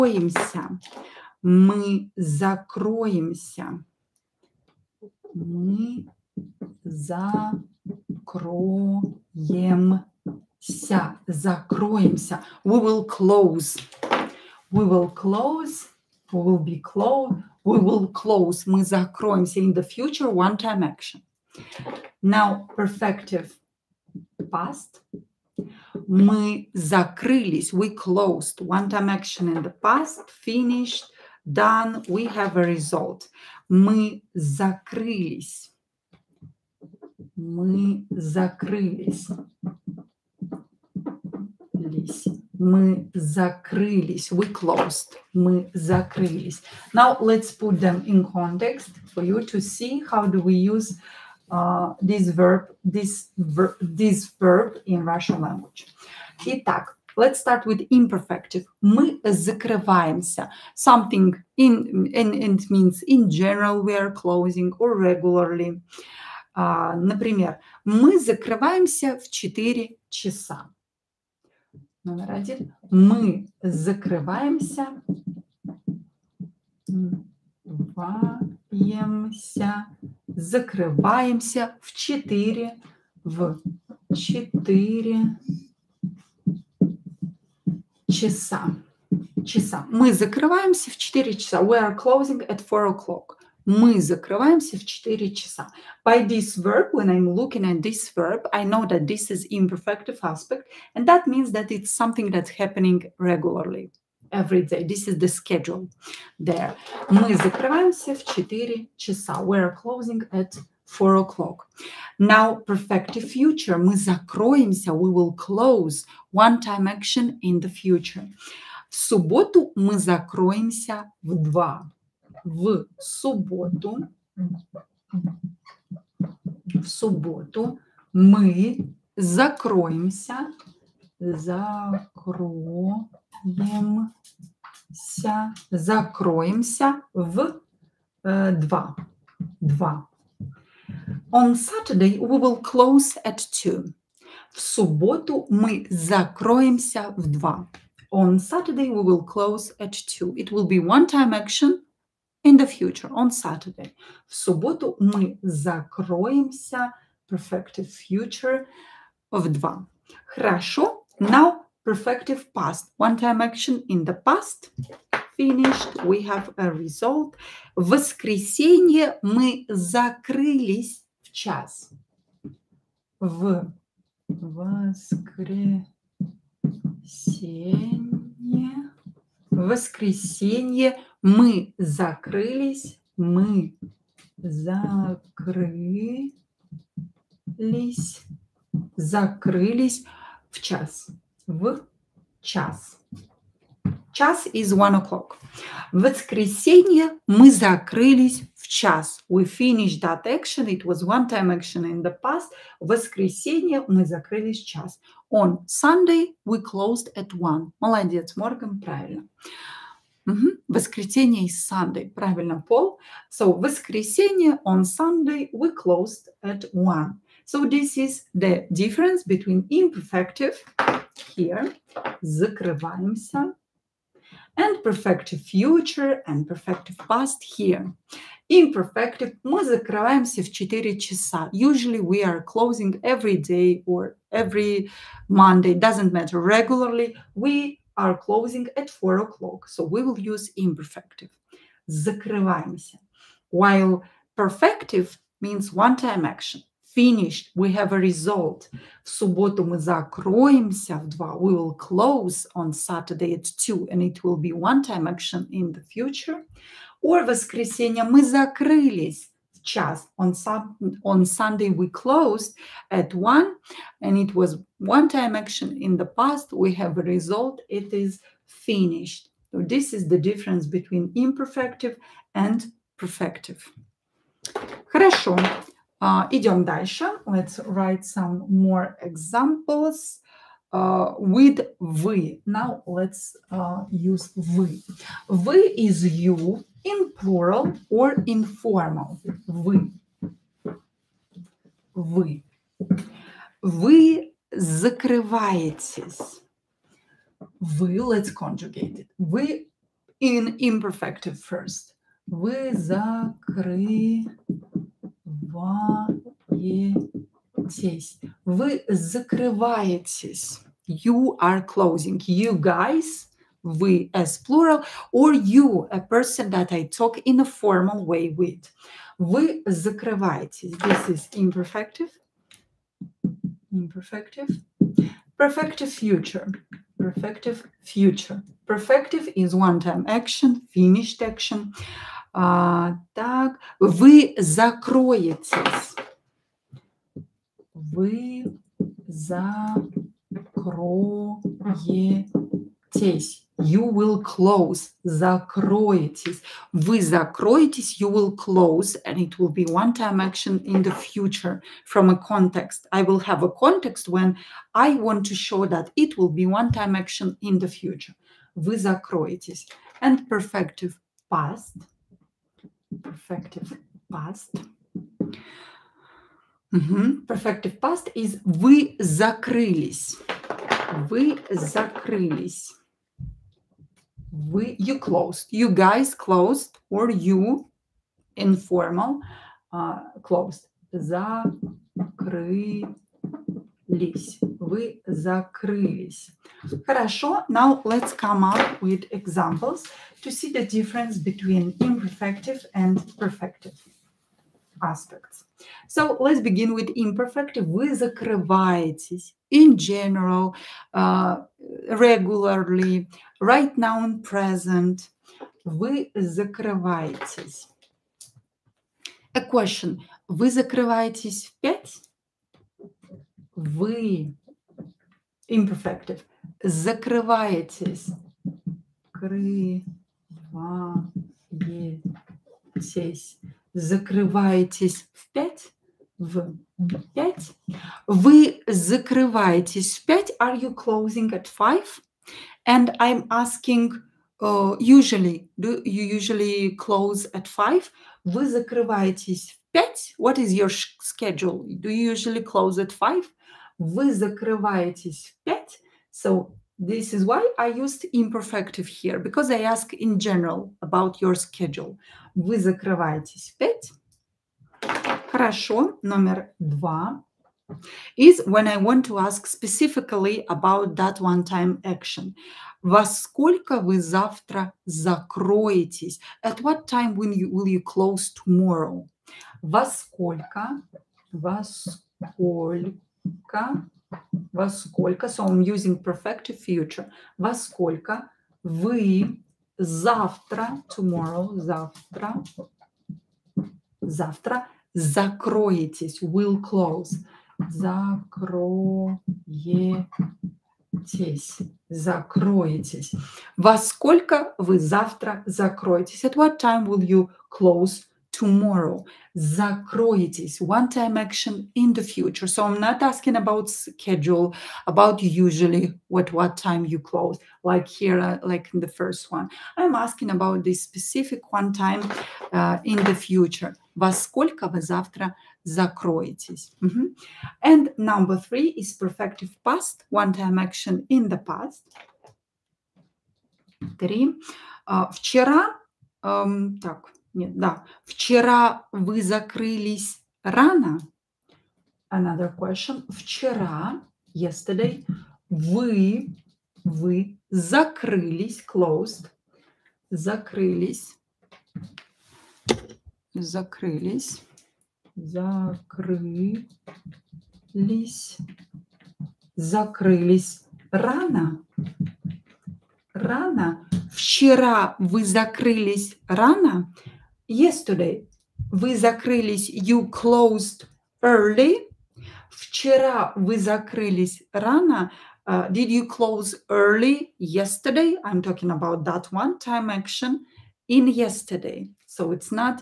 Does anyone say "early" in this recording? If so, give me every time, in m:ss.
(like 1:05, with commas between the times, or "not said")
9:21, 9:26.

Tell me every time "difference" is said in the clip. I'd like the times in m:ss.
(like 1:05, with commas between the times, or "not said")
3:38, 4:30, 6:30.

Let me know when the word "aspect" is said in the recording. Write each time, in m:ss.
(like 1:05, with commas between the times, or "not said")
1:40, 6:34.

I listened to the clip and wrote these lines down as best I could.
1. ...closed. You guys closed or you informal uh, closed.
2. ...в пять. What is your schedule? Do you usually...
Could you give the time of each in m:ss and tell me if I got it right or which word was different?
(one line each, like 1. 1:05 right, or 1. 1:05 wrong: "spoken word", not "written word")
1. 6:14 right
2. 7:19 right.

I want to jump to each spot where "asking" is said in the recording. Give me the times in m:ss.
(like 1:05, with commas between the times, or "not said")
7:13, 8:23, 8:29.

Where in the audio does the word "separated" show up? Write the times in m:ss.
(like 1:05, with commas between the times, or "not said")
not said.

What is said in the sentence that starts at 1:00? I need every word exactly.
Something in, and, it means in general we are closing or regularly.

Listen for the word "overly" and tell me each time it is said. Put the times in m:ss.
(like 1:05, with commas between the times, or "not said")
not said.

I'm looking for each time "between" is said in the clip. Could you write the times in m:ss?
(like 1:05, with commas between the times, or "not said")
3:39, 4:30, 6:31.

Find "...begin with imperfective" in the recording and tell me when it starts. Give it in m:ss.
6:36.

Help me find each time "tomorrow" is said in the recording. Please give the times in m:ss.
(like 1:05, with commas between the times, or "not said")
7:48, 8:00, 8:18.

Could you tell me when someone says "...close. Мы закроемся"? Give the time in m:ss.
0:18.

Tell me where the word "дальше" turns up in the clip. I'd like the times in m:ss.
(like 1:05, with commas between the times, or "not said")
4:36.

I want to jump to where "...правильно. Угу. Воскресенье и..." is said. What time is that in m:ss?
3:28.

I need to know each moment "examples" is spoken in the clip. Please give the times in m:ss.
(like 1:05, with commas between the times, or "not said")
4:39, 6:29.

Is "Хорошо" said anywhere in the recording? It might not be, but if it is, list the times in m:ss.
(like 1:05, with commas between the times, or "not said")
2:40, 4:34, 6:26, 7:35.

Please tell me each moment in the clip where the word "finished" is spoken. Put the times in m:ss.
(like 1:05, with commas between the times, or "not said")
0:30, 2:45, 3:19, 4:06, 4:28, 5:30.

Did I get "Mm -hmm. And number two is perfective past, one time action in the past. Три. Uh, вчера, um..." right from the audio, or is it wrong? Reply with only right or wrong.
wrong.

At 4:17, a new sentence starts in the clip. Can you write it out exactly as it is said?
Or воскресенье мы закрылись в час.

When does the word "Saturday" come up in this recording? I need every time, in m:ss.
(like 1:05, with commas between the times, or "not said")
2:21, 2:28, 2:33, 4:12.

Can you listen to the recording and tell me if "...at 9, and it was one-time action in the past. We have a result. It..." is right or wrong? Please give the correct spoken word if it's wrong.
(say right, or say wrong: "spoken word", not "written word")
wrong: "1", not "9".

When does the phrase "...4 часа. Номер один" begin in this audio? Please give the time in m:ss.
1:09.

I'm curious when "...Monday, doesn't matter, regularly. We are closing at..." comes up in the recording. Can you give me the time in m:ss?
3:55.